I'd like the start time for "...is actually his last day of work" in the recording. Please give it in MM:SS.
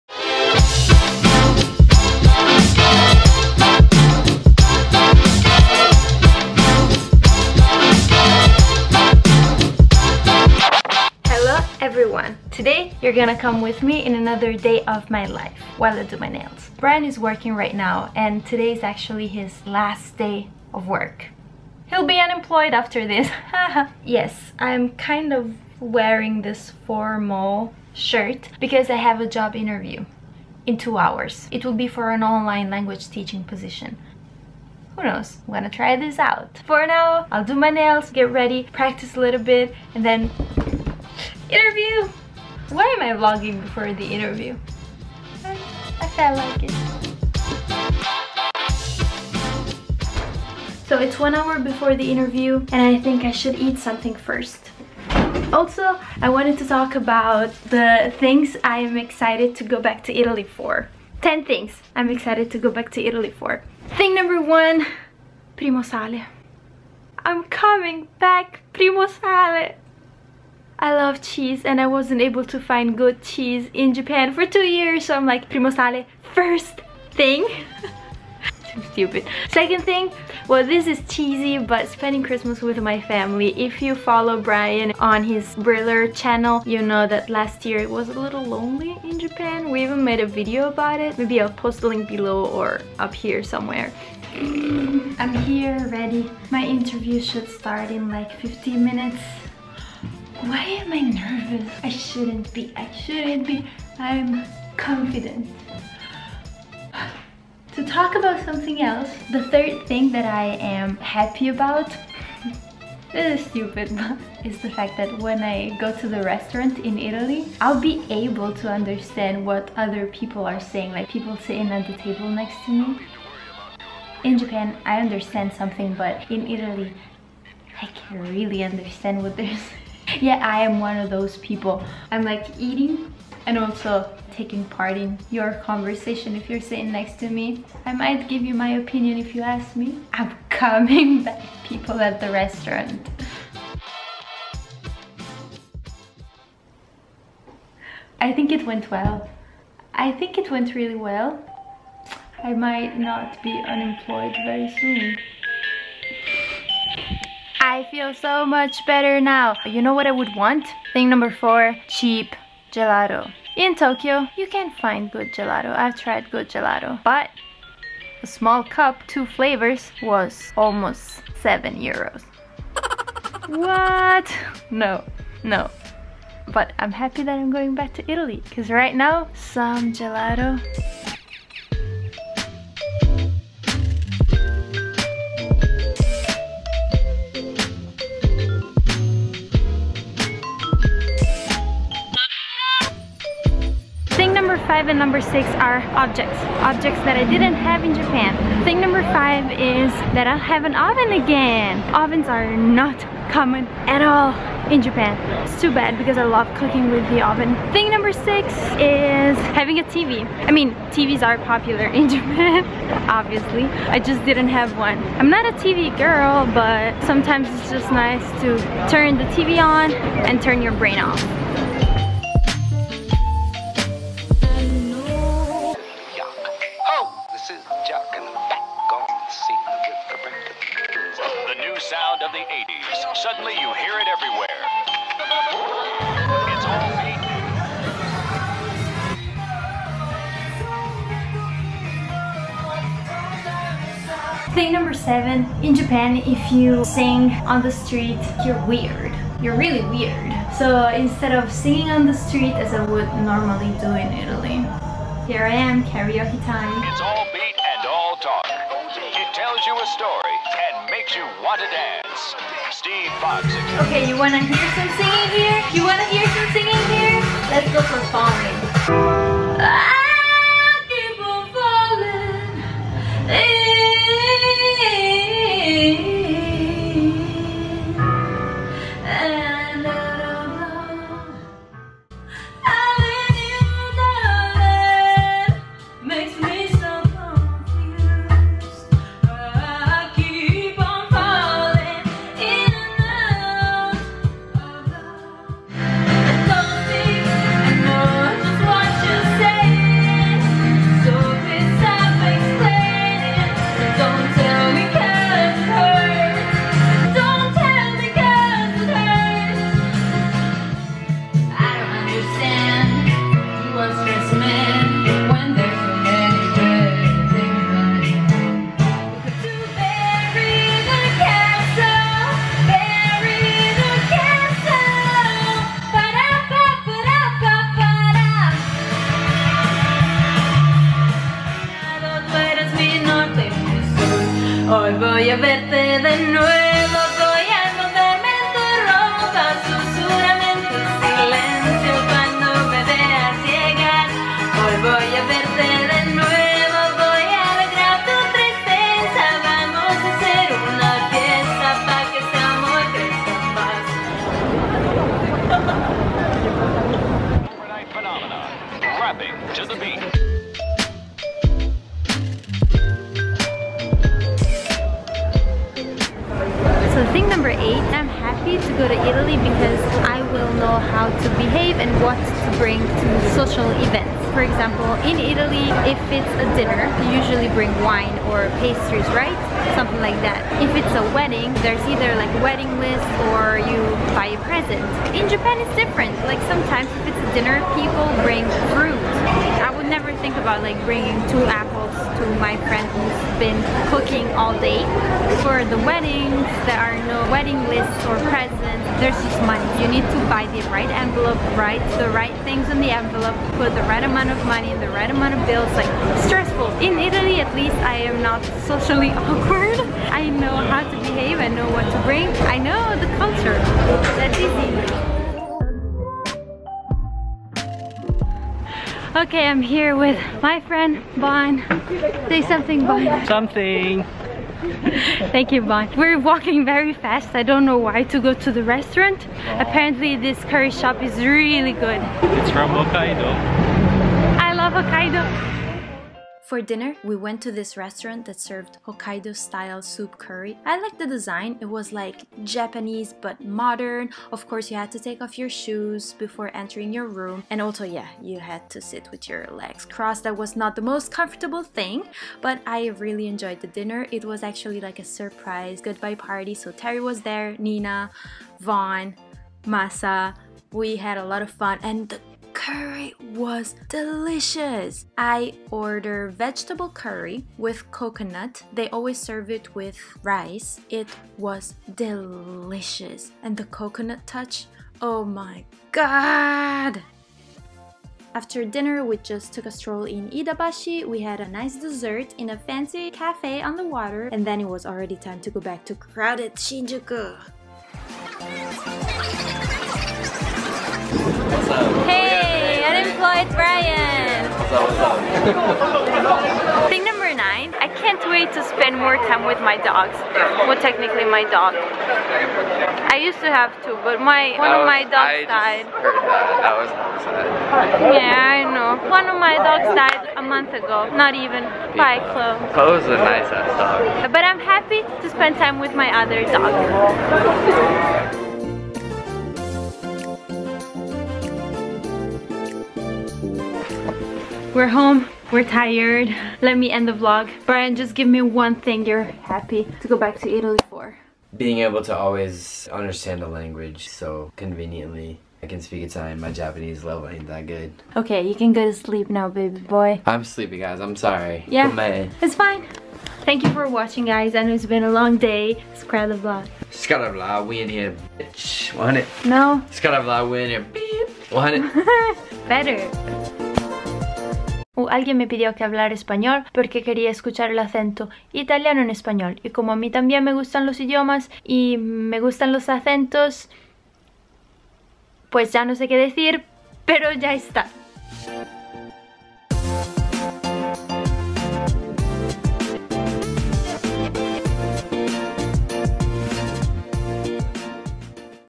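00:18.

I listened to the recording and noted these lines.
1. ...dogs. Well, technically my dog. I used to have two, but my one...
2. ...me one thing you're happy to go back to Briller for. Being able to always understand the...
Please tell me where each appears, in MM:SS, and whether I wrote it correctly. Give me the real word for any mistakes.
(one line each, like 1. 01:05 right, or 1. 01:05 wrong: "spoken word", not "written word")
1. 08:19 right
2. 08:48 wrong: "Italy", not "Briller".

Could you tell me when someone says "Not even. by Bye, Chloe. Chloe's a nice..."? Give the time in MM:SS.
08:31.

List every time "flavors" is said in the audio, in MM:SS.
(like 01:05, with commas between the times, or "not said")
02:49.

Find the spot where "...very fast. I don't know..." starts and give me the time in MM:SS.
07:06.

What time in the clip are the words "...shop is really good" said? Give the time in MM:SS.
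07:10.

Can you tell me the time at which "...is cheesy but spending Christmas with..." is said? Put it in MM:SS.
01:20.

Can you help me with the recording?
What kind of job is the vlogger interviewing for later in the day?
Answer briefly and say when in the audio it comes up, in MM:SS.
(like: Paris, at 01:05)
Online language teaching, at 00:32.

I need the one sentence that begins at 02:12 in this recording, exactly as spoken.
I'm like eating and also taking part in your conversation if you're sitting next to me.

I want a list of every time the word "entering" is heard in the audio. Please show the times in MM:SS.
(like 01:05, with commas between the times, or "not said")
07:26.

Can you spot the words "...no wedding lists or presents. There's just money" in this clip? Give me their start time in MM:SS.
06:37.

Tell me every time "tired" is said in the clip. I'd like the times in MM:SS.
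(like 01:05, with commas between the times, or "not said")
08:45.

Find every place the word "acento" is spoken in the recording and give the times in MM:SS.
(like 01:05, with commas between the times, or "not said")
09:17, 09:22.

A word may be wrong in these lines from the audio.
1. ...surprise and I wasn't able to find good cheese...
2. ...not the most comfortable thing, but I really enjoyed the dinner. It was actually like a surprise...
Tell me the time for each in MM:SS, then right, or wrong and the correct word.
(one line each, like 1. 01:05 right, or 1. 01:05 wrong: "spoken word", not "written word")
1. 01:11 wrong: "cheese", not "surprise"
2. 07:30 right.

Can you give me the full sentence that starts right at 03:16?
Objects that I didn't have in Japan.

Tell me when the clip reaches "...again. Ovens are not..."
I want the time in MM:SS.
03:21.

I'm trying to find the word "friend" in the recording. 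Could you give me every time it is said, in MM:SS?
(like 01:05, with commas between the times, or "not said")
06:32, 07:00.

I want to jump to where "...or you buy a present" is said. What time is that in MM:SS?
06:23.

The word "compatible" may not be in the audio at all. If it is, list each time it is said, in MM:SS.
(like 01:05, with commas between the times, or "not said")
not said.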